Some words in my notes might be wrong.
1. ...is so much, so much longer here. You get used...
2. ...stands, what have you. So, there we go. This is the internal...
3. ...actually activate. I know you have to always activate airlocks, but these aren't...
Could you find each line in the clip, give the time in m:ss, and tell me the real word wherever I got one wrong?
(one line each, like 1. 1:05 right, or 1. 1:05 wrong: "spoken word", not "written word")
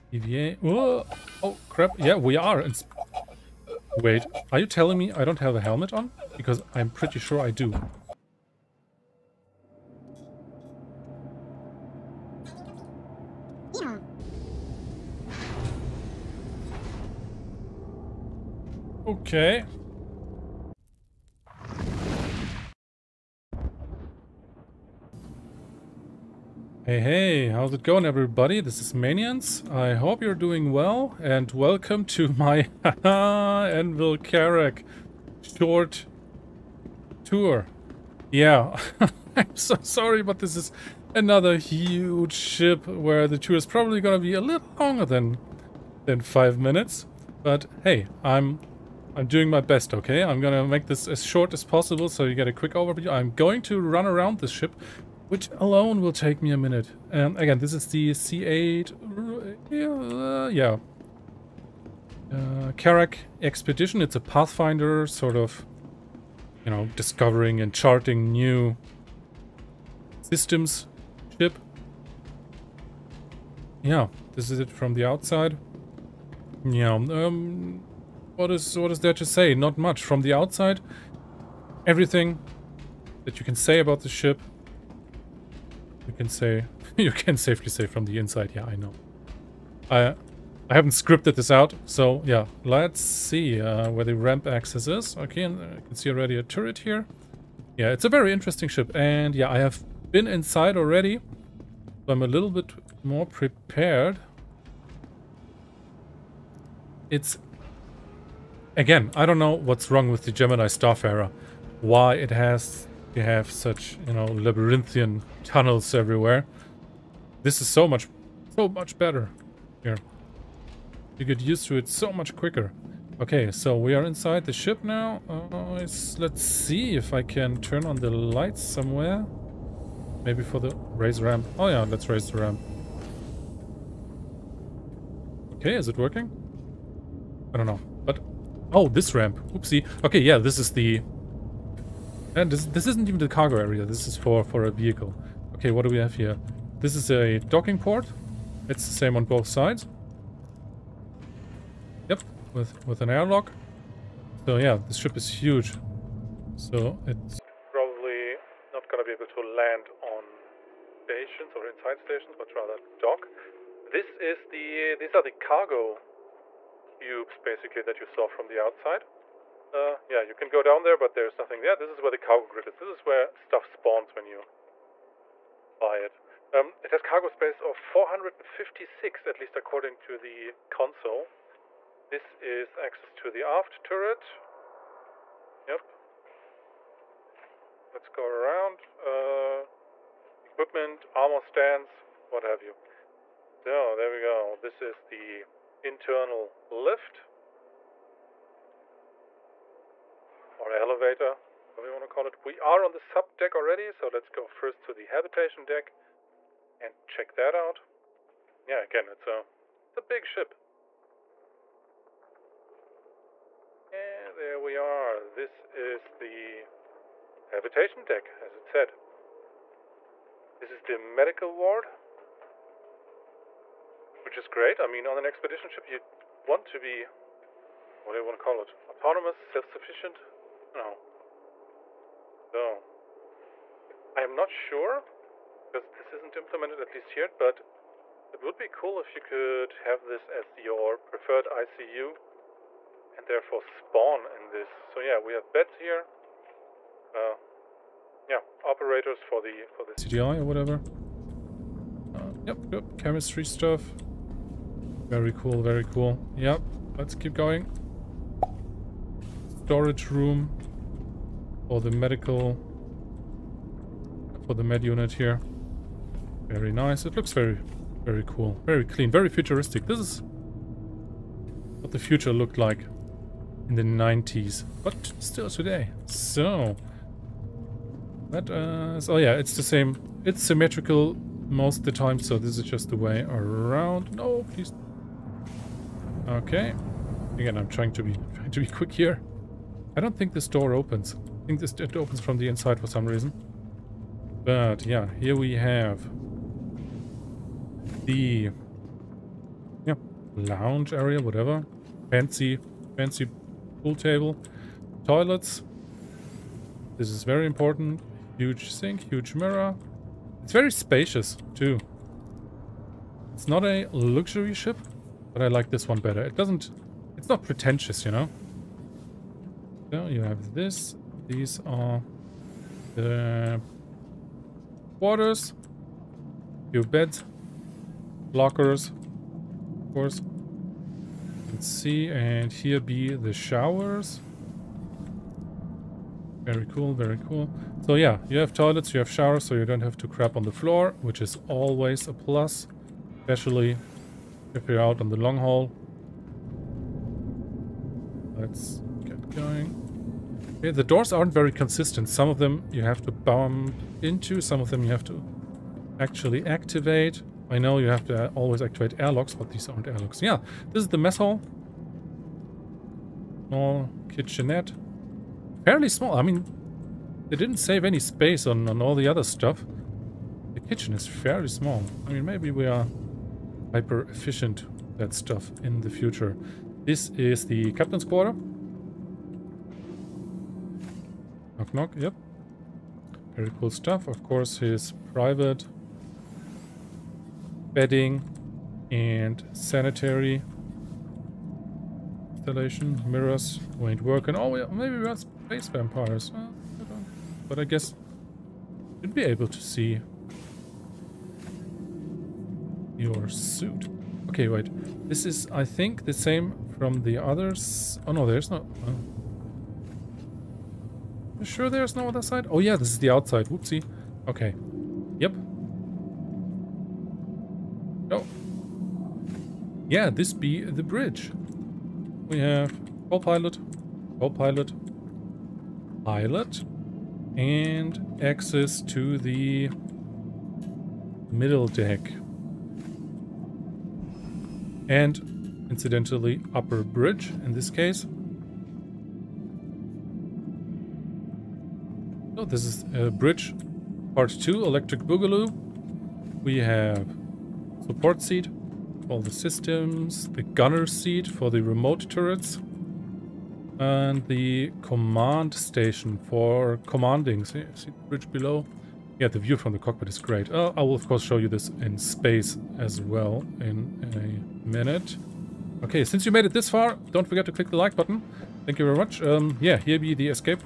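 1. 1:57 wrong: "better", not "longer"
2. 3:11 right
3. 5:55 right.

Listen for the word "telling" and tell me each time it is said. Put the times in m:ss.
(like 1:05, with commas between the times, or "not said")
0:04.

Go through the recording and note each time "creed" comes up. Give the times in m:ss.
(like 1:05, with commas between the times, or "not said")
not said.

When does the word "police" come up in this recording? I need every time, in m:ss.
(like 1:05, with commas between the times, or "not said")
not said.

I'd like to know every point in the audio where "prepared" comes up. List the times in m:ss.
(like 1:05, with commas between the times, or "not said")
1:43.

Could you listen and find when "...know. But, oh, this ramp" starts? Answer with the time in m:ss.
2:17.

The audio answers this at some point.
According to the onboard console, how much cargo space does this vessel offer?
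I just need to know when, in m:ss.
2:57.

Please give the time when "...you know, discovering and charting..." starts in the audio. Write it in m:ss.
1:06.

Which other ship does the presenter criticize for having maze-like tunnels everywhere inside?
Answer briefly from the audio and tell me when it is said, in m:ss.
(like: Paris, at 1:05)
Gemini Starfarer, at 1:50.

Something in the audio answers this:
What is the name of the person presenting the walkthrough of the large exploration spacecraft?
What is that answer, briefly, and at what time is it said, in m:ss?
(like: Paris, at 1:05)
Maniance, at 0:28.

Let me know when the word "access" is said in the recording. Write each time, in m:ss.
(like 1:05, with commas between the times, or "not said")
1:34, 3:02, 7:08.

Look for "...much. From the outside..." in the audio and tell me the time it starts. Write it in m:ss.
1:19.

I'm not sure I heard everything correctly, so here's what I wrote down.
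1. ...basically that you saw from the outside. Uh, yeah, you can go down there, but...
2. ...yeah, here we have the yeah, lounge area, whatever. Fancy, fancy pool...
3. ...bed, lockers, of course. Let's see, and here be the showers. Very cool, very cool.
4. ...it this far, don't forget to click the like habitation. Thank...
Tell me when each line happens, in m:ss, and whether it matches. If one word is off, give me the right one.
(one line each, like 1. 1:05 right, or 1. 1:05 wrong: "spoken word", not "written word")
1. 2:47 right
2. 4:54 right
3. 5:26 right
4. 7:46 wrong: "button", not "habitation".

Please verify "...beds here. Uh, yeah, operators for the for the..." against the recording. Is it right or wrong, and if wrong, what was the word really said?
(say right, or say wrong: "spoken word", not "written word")
right.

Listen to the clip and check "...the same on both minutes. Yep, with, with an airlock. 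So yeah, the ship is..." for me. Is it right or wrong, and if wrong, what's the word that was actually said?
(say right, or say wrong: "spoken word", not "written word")
wrong: "sides", not "minutes".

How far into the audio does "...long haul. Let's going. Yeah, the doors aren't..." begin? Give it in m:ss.
5:45.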